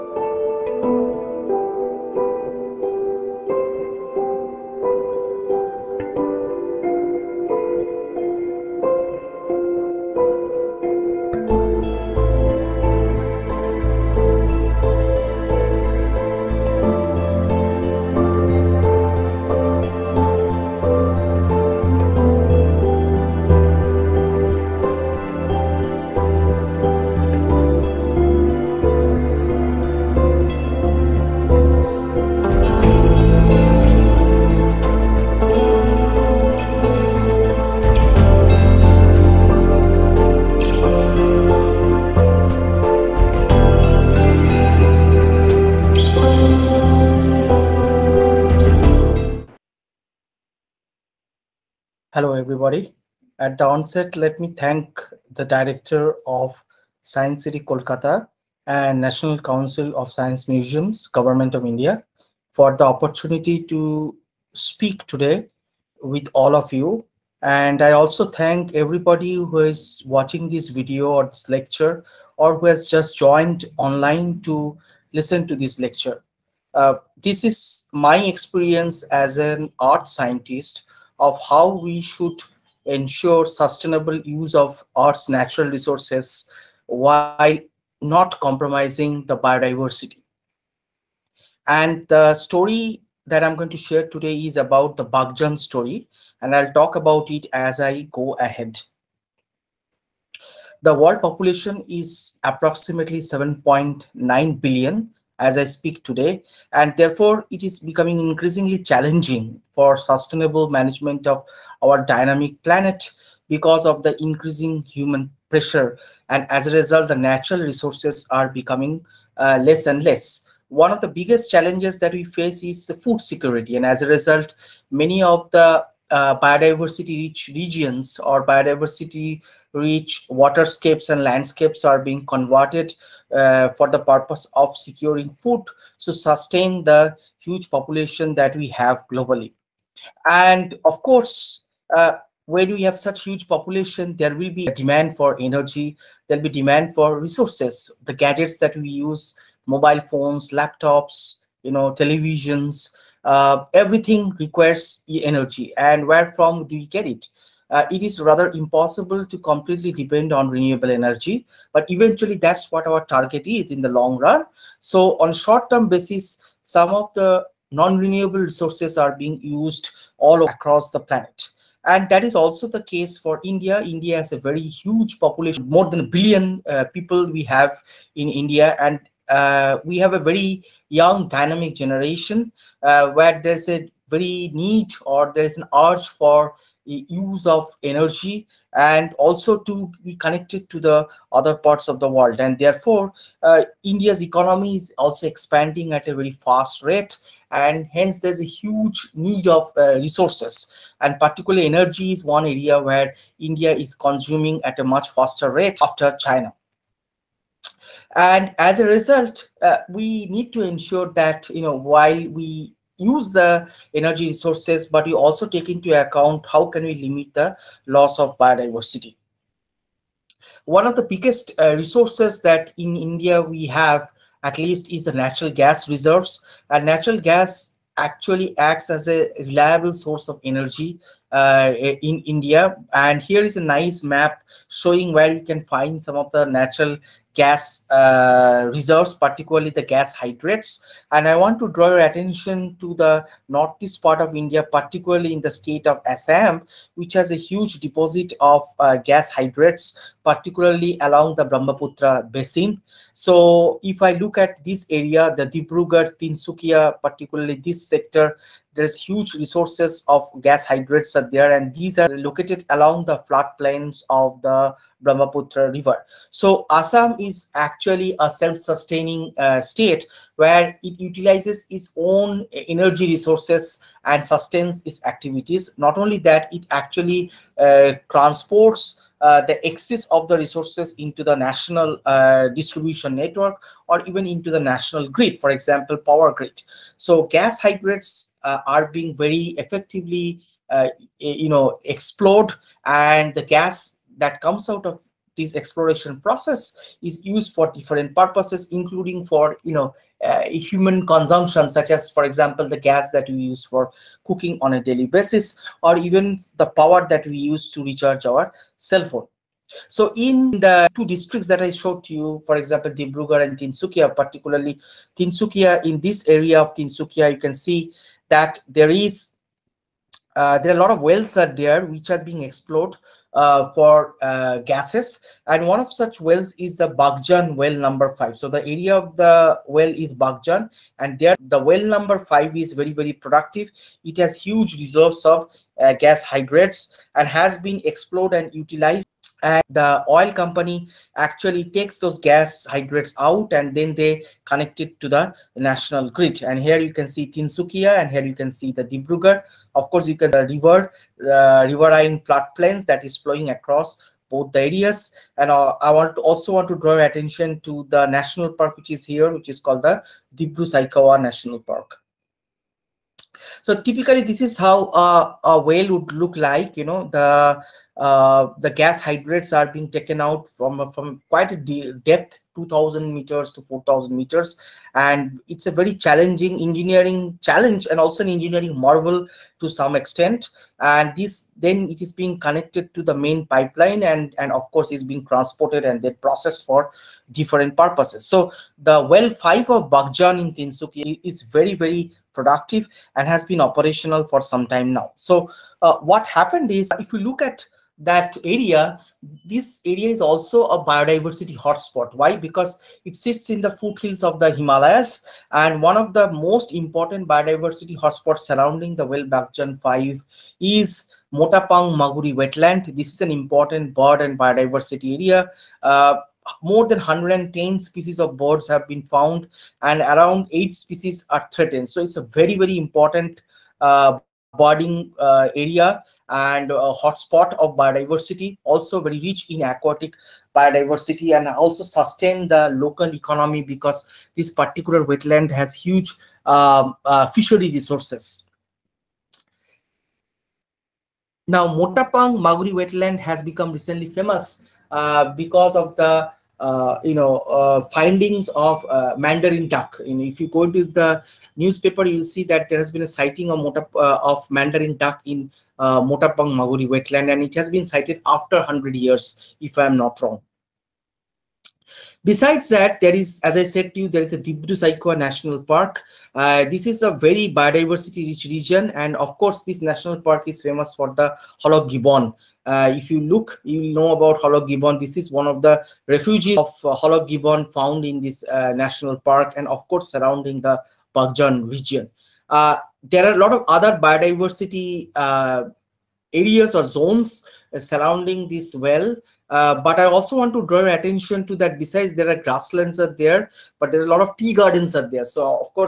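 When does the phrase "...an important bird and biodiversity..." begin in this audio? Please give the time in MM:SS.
06:53.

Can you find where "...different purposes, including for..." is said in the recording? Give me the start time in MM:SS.
04:57.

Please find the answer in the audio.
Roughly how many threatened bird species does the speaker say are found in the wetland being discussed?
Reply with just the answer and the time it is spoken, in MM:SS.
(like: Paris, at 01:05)
8, at 07:00.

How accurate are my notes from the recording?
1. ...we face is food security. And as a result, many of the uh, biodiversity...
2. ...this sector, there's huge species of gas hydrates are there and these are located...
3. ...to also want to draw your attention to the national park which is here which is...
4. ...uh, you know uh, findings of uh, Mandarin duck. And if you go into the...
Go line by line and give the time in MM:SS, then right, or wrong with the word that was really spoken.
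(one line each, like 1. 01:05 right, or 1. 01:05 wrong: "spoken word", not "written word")
1. 02:02 right
2. 04:17 wrong: "resources", not "species"
3. 05:56 right
4. 07:26 right.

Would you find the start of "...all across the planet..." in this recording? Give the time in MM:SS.
02:50.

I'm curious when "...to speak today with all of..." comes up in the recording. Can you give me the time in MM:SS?
01:03.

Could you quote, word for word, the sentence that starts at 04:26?
So Assam is actually a self-sustaining uh, state where it utilizes its own energy resources and sustains its activities.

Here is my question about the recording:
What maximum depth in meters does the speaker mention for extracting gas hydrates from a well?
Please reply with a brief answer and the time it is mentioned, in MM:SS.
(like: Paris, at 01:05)
4000 meters, at 06:13.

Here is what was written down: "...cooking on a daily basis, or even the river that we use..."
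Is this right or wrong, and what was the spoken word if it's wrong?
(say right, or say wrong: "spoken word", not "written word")
wrong: "power", not "river".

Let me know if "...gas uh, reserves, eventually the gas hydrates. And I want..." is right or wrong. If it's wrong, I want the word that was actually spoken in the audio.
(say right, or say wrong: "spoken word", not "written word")
wrong: "particularly", not "eventually".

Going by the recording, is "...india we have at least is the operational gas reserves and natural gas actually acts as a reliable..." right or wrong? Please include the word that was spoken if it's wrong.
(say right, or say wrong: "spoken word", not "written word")
wrong: "natural", not "operational".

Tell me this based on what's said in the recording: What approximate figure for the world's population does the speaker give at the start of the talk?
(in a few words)
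7.9 billion.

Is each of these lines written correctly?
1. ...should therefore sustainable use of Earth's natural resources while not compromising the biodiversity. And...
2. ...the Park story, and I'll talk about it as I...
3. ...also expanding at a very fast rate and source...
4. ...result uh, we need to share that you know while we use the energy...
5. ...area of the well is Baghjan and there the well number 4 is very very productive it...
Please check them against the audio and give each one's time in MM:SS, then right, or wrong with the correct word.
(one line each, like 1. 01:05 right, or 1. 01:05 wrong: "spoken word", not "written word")
1. 01:21 wrong: "ensure", not "therefore"
2. 01:34 wrong: "Baghjan", not "Park"
3. 03:14 wrong: "hence", not "source"
4. 03:28 wrong: "ensure", not "share"
5. 05:28 wrong: "5", not "4".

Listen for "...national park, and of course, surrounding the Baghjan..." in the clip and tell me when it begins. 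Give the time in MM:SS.
07:58.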